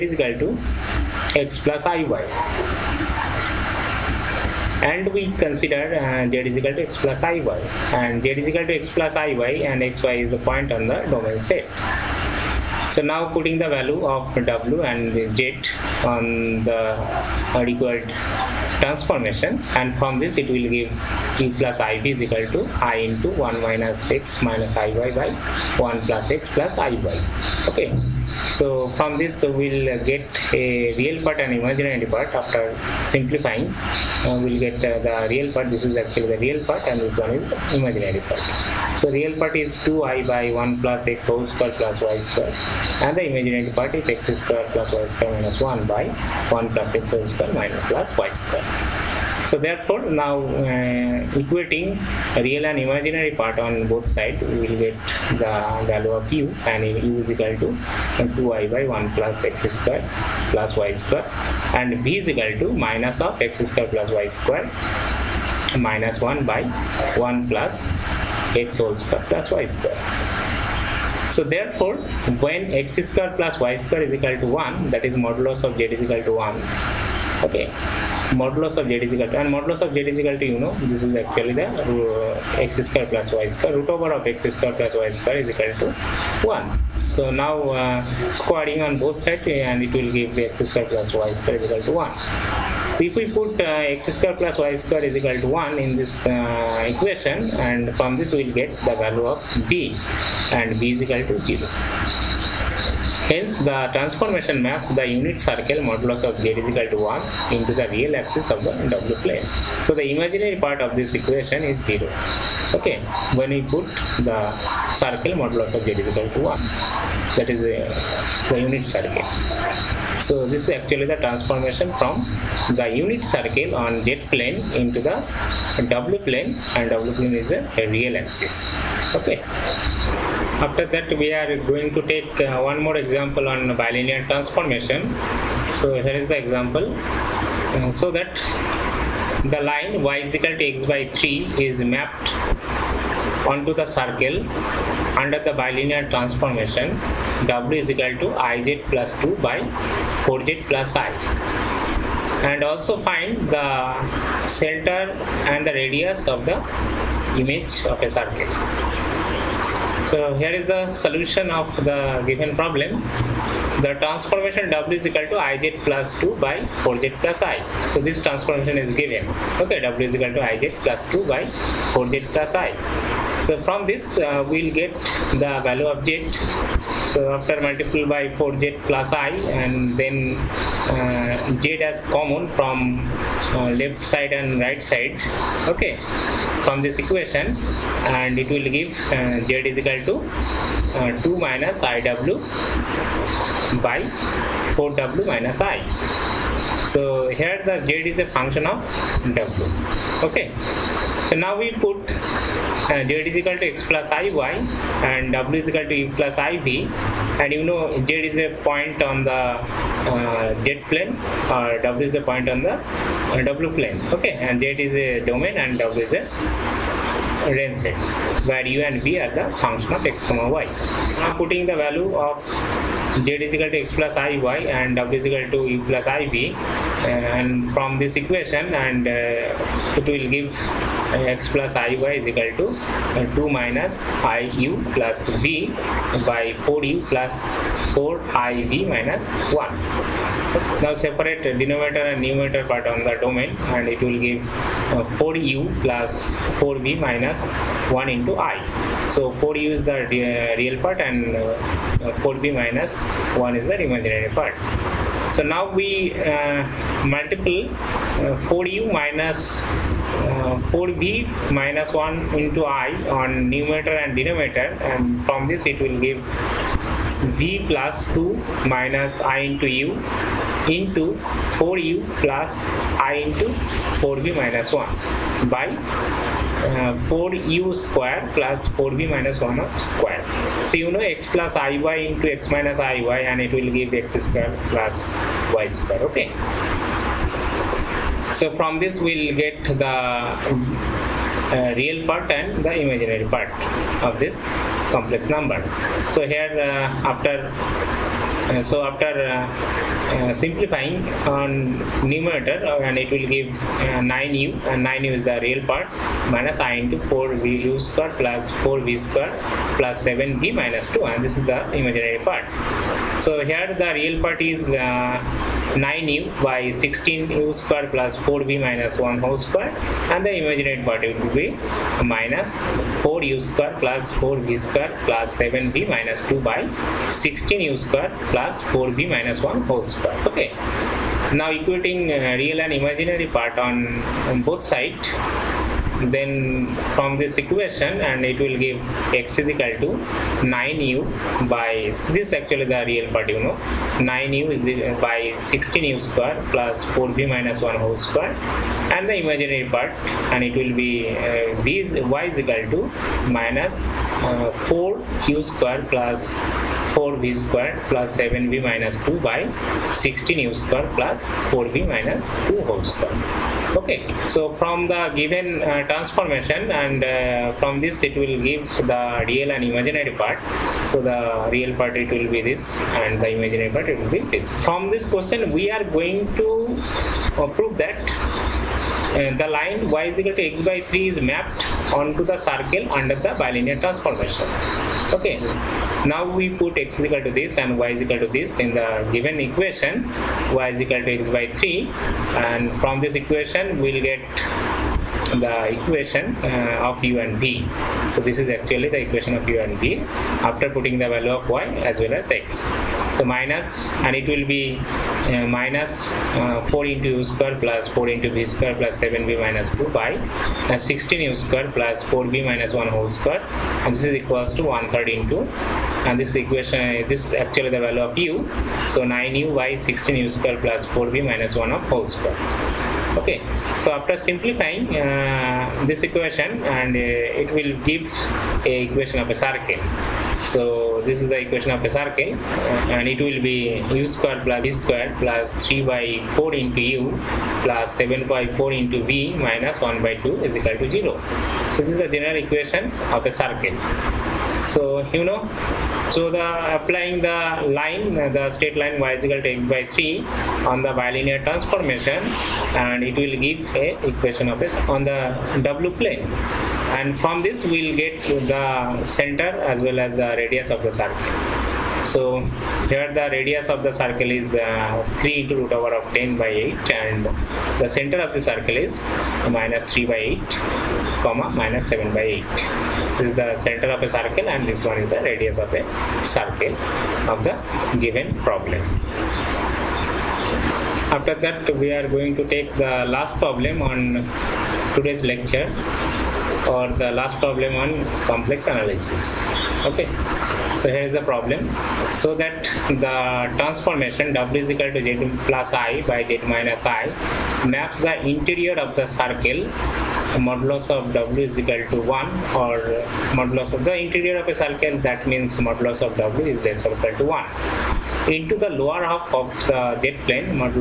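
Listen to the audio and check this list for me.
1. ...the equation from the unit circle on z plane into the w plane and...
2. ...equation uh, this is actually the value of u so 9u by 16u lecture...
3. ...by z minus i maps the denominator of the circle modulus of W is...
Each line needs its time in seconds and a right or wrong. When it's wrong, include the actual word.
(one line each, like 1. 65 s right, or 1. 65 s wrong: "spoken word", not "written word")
1. 121 s wrong: "transformation", not "equation"
2. 416 s wrong: "square", not "lecture"
3. 496 s wrong: "interior", not "denominator".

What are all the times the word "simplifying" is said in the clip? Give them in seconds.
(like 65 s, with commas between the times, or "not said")
33 s, 300 s, 424 s.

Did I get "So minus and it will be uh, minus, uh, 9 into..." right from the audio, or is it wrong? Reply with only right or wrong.
wrong.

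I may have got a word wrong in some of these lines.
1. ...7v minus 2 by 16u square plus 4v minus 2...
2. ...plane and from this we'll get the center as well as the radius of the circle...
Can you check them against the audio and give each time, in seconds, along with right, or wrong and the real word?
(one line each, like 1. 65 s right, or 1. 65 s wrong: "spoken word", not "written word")
1. 358 s right
2. 456 s right.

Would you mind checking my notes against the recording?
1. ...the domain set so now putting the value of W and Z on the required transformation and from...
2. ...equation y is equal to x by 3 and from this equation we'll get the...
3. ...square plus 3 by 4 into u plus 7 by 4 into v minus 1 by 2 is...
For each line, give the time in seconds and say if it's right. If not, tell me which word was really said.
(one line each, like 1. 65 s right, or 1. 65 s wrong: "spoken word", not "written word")
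1. 10 s right
2. 389 s right
3. 434 s right.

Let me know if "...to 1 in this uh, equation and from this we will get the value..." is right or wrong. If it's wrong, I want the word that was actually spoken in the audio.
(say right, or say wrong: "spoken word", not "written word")
right.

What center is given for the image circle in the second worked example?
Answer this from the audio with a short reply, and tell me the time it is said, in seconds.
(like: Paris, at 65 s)
(-3/8, -7/8), at 469 s.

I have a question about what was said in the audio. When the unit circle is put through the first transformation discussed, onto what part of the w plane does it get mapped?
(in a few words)
The real axis.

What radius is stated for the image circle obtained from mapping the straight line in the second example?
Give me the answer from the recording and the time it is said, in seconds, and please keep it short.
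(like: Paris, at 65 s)
3√10/8, at 465 s.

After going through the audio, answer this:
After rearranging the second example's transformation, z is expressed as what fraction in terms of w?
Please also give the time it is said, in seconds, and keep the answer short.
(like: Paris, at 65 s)
(2 - iw)/(4w - i), at 191 s.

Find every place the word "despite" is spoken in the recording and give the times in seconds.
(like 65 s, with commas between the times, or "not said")
not said.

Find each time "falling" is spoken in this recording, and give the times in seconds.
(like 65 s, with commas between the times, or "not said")
not said.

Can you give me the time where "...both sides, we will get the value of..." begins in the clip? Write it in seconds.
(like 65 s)
53 s.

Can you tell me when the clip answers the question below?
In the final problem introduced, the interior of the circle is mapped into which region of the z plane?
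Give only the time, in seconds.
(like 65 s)
508 s.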